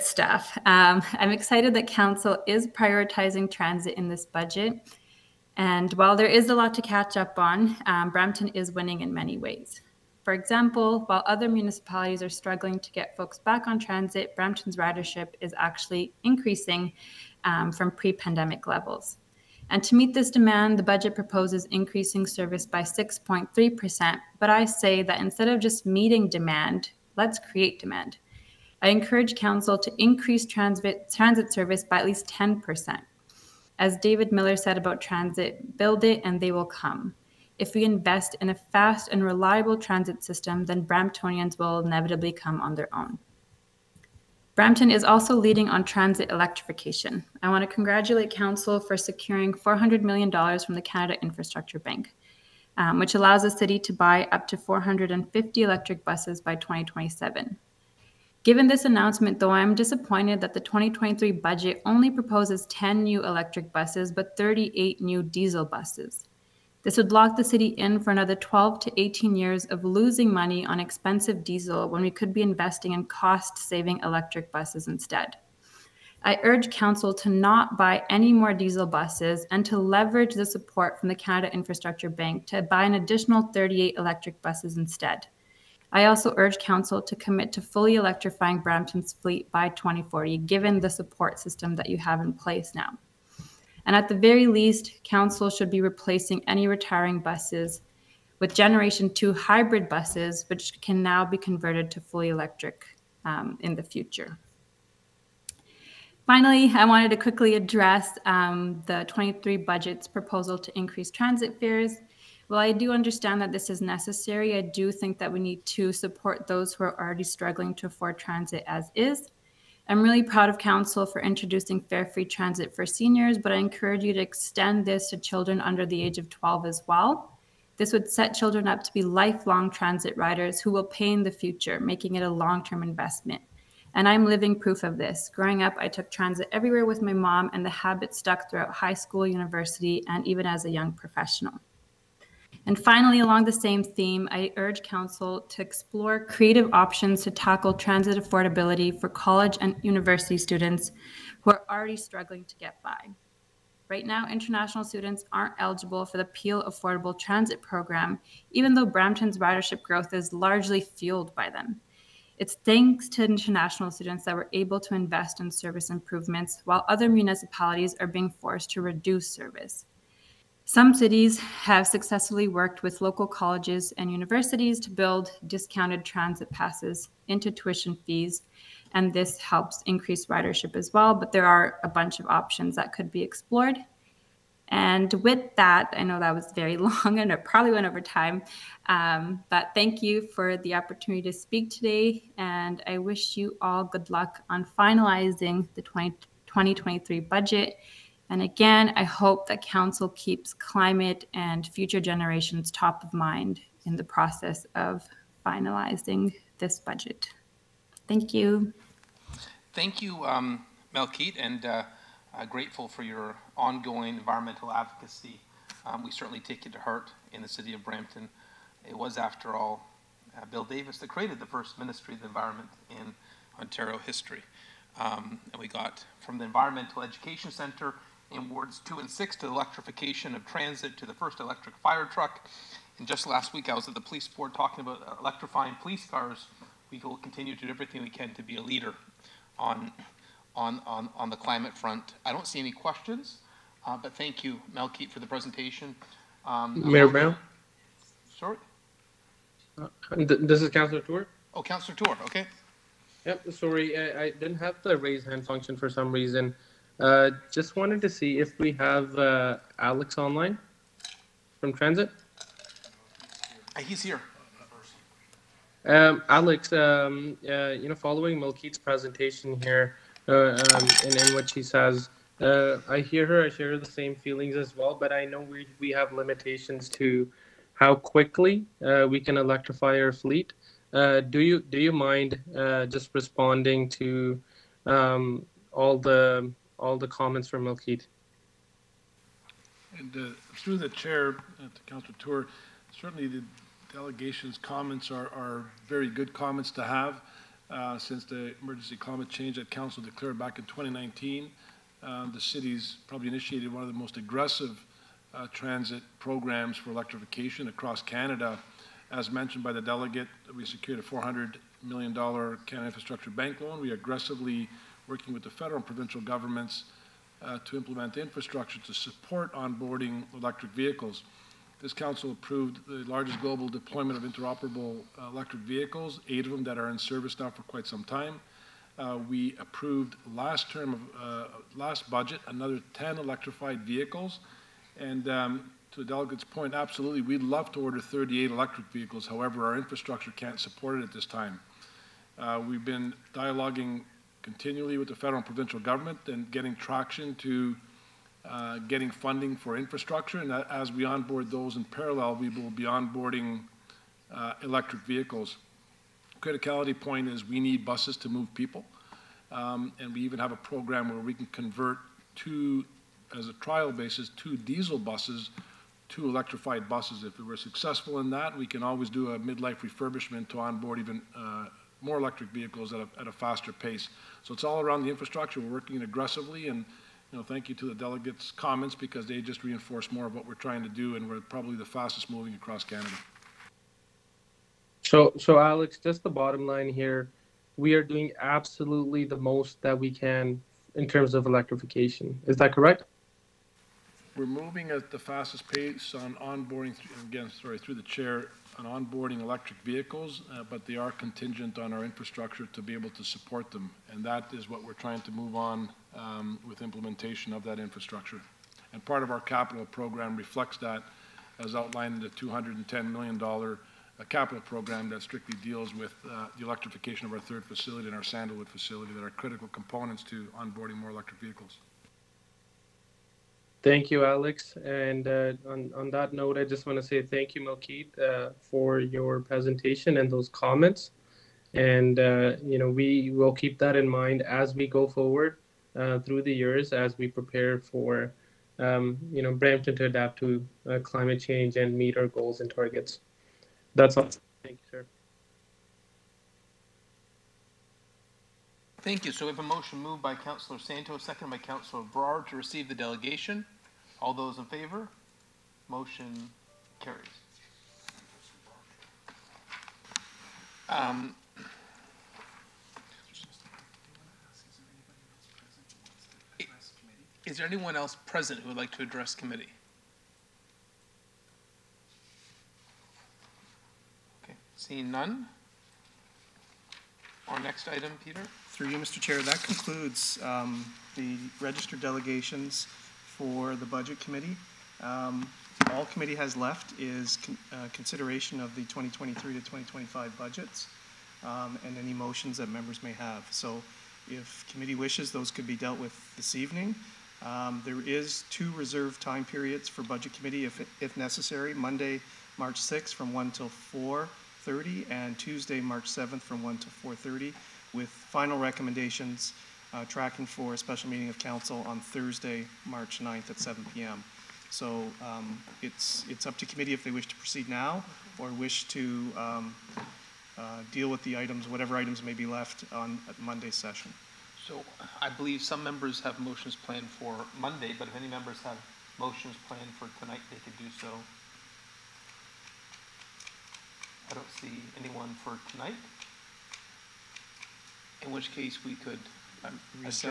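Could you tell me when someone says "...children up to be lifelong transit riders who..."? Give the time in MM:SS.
02:08.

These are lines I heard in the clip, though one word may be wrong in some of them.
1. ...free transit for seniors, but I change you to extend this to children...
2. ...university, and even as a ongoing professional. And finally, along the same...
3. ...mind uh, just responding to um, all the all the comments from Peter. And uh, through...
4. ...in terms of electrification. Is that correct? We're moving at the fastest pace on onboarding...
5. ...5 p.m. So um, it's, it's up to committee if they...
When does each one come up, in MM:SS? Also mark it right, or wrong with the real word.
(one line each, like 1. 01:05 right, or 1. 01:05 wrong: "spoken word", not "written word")
1. 02:02 wrong: "encourage", not "change"
2. 02:19 wrong: "young", not "ongoing"
3. 04:41 wrong: "Milkheed", not "Peter"
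4. 06:30 right
5. 08:33 wrong: "7", not "5".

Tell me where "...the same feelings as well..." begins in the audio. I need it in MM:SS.
04:33.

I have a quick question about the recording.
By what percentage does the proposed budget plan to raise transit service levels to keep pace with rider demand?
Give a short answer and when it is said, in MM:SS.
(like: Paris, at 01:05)
6.3%, at 00:22.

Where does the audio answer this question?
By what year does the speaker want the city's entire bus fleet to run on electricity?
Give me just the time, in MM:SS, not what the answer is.
01:29.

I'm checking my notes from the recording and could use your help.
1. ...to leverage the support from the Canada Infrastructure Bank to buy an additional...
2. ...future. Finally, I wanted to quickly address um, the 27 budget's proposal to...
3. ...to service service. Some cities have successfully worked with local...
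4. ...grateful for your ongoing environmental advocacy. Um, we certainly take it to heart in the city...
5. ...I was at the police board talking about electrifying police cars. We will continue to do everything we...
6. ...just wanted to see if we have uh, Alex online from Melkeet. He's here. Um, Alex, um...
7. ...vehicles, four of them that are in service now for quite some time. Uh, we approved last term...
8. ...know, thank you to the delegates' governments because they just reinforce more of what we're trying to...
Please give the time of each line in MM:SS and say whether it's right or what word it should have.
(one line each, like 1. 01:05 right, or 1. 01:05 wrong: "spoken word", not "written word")
1. 01:19 right
2. 01:43 wrong: "23", not "27"
3. 02:48 wrong: "reduce", not "service"
4. 03:32 right
5. 03:53 right
6. 04:17 wrong: "Transit", not "Melkeet"
7. 05:25 wrong: "eight", not "four"
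8. 06:17 wrong: "comments", not "governments".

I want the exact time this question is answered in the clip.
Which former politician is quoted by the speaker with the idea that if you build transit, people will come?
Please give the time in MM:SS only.
00:33.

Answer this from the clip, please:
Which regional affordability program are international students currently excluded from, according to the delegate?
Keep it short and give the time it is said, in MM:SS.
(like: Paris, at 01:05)
Peel Affordable Transit Program, at 02:36.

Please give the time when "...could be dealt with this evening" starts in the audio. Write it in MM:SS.
08:15.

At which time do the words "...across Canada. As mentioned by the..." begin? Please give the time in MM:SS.
05:07.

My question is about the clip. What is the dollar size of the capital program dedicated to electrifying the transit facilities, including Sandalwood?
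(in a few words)
$210 million.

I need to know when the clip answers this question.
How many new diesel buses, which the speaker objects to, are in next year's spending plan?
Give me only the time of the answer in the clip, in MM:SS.
01:04.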